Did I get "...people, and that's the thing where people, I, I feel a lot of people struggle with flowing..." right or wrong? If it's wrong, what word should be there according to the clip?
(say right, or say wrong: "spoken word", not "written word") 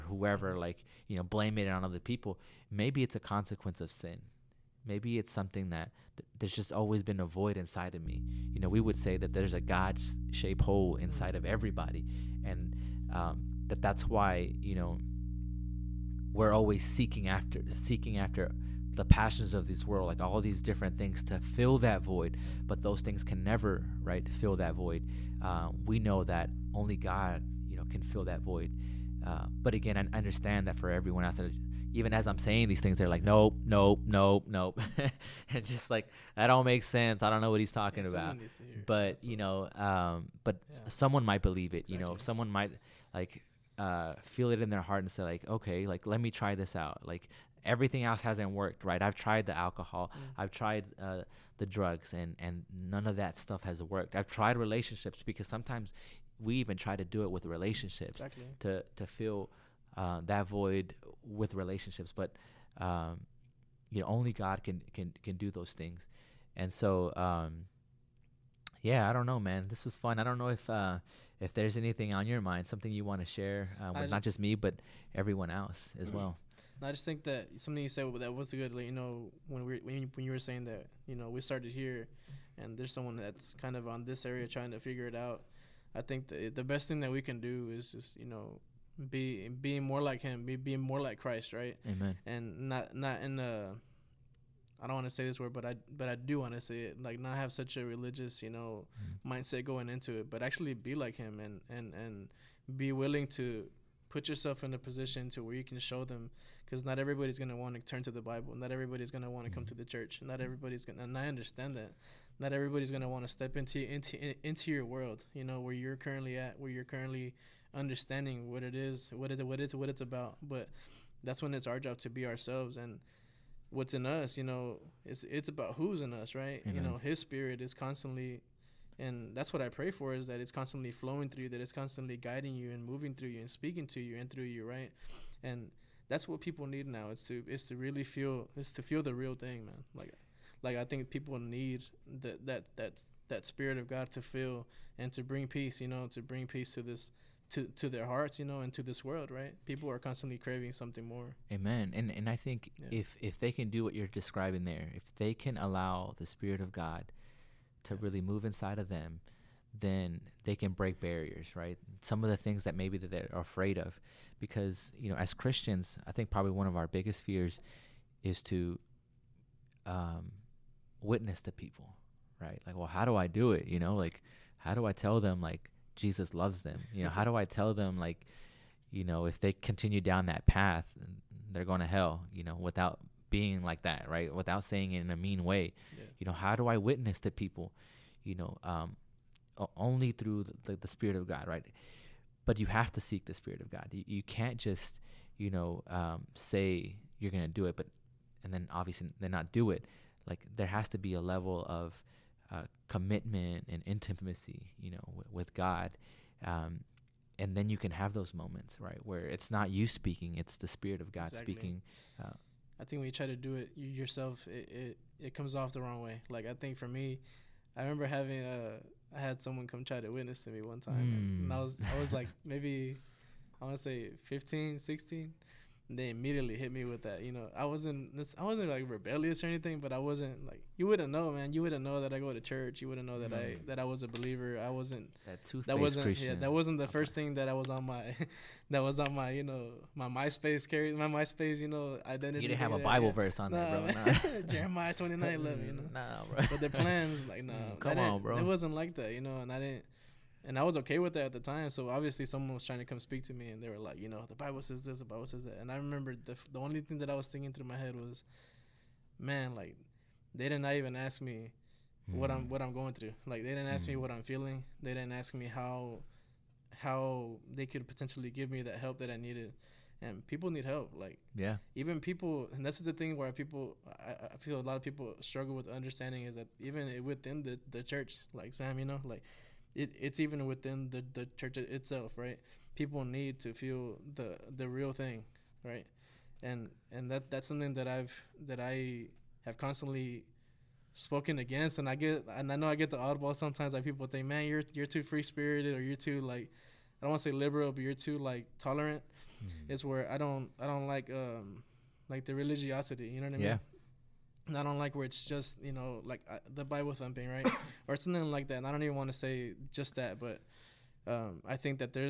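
wrong: "understanding", not "flowing".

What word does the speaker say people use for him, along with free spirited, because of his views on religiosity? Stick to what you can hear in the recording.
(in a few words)
Tolerant.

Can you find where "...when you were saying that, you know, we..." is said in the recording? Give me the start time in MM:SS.
01:20.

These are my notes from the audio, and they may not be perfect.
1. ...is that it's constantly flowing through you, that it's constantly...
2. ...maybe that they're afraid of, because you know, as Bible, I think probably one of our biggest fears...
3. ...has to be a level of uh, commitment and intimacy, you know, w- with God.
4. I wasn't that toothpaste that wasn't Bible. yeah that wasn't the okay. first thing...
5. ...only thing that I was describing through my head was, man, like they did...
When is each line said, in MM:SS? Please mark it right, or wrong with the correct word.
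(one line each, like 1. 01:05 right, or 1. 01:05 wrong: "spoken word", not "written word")
1. 02:10 right
2. 02:42 wrong: "Christians", not "Bible"
3. 03:20 right
4. 03:54 wrong: "Christian", not "Bible"
5. 04:16 wrong: "thinking", not "describing".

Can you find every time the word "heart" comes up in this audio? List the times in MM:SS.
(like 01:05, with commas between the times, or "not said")
00:44, 02:28.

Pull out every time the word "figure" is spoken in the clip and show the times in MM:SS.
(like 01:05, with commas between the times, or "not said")
01:24.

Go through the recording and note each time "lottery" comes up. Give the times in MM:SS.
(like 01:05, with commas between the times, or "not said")
not said.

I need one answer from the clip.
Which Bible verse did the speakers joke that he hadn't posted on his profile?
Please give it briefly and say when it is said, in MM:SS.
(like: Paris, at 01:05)
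Jeremiah 29:11, at 04:04.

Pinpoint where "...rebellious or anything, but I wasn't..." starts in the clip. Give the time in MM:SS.
03:48.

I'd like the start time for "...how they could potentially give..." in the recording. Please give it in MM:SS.
04:26.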